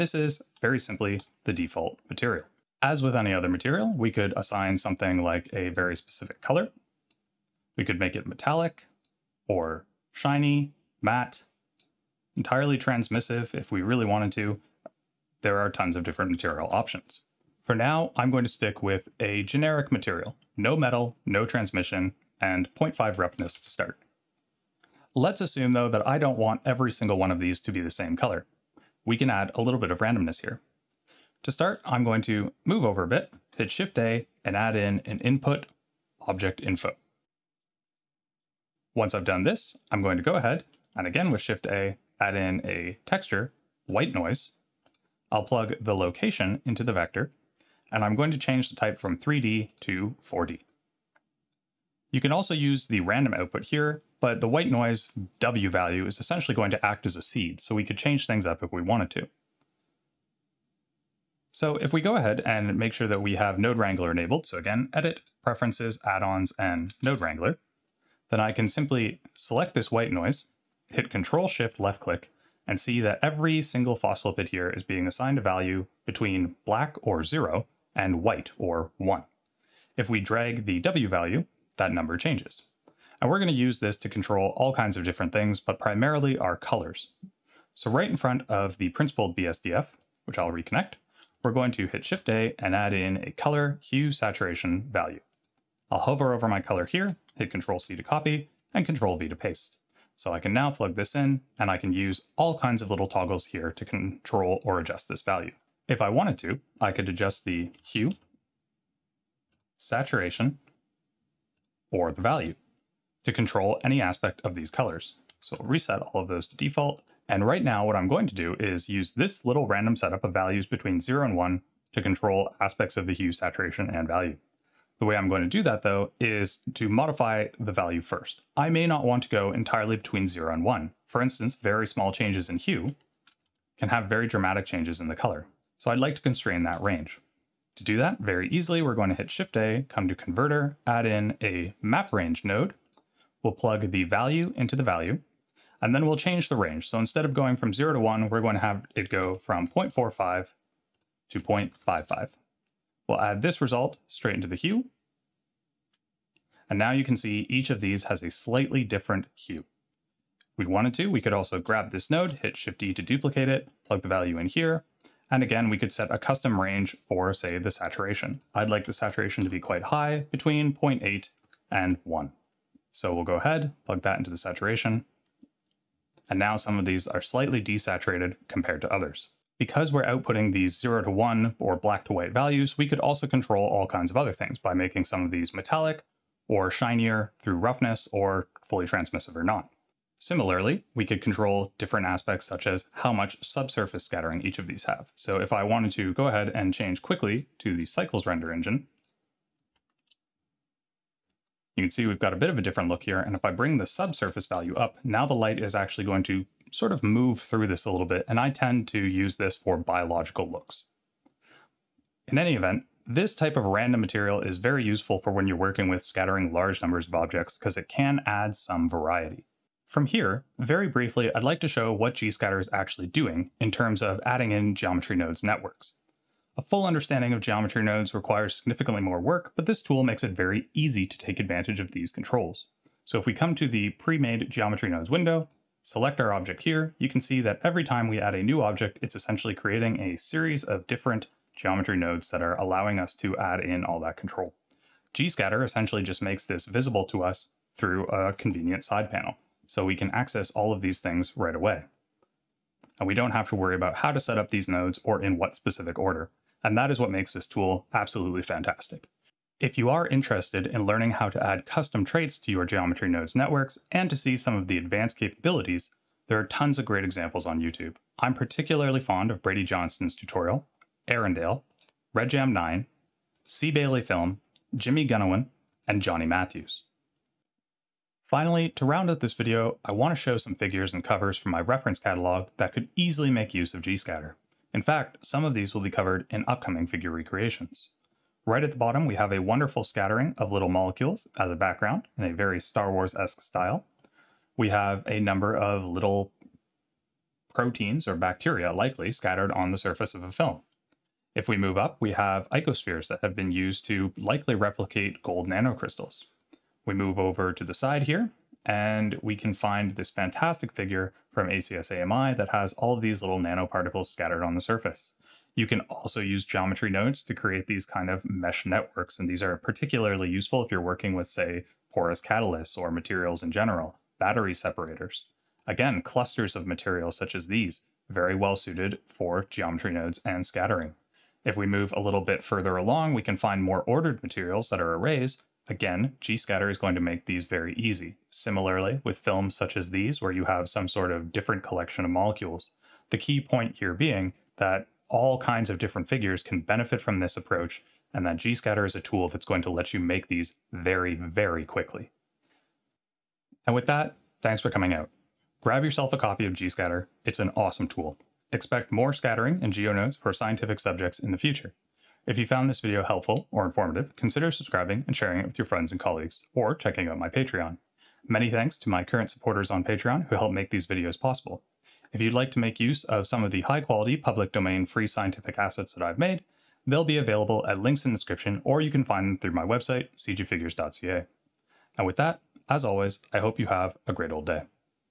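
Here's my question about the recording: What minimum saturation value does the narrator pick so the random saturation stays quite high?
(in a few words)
0.8.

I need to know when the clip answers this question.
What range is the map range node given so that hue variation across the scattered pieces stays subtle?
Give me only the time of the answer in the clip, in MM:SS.
02:29.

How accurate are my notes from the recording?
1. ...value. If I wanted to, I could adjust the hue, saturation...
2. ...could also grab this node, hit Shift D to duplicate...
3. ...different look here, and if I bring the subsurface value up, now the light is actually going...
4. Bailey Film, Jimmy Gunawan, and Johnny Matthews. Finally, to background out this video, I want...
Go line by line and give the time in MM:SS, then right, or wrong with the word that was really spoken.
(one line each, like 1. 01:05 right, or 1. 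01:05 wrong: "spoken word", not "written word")
1. 01:45 right
2. 02:41 right
3. 03:22 right
4. 04:33 wrong: "round", not "background".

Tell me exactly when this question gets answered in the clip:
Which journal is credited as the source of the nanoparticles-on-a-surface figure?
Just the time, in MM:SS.
05:11.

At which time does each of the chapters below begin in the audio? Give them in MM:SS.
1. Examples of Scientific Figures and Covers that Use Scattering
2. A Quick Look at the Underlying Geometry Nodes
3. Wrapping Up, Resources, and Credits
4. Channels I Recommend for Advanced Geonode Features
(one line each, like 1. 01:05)
1. 04:36
2. 03:41
3. 05:53
4. 04:16.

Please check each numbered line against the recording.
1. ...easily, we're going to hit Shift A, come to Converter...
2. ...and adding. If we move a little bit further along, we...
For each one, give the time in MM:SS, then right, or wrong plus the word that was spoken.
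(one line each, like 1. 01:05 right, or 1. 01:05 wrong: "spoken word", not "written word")
1. 02:18 right
2. 05:30 wrong: "scattering", not "adding".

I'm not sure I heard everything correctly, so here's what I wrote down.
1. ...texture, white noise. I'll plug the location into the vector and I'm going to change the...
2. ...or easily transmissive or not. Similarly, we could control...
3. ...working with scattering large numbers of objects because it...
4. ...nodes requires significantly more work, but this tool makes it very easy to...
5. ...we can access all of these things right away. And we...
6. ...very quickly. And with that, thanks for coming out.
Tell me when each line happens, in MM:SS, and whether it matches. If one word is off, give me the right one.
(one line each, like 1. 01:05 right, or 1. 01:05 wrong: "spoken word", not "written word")
1. 00:43 right
2. 03:08 wrong: "fully", not "easily"
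3. 03:35 right
4. 03:47 right
5. 04:09 right
6. 05:51 right.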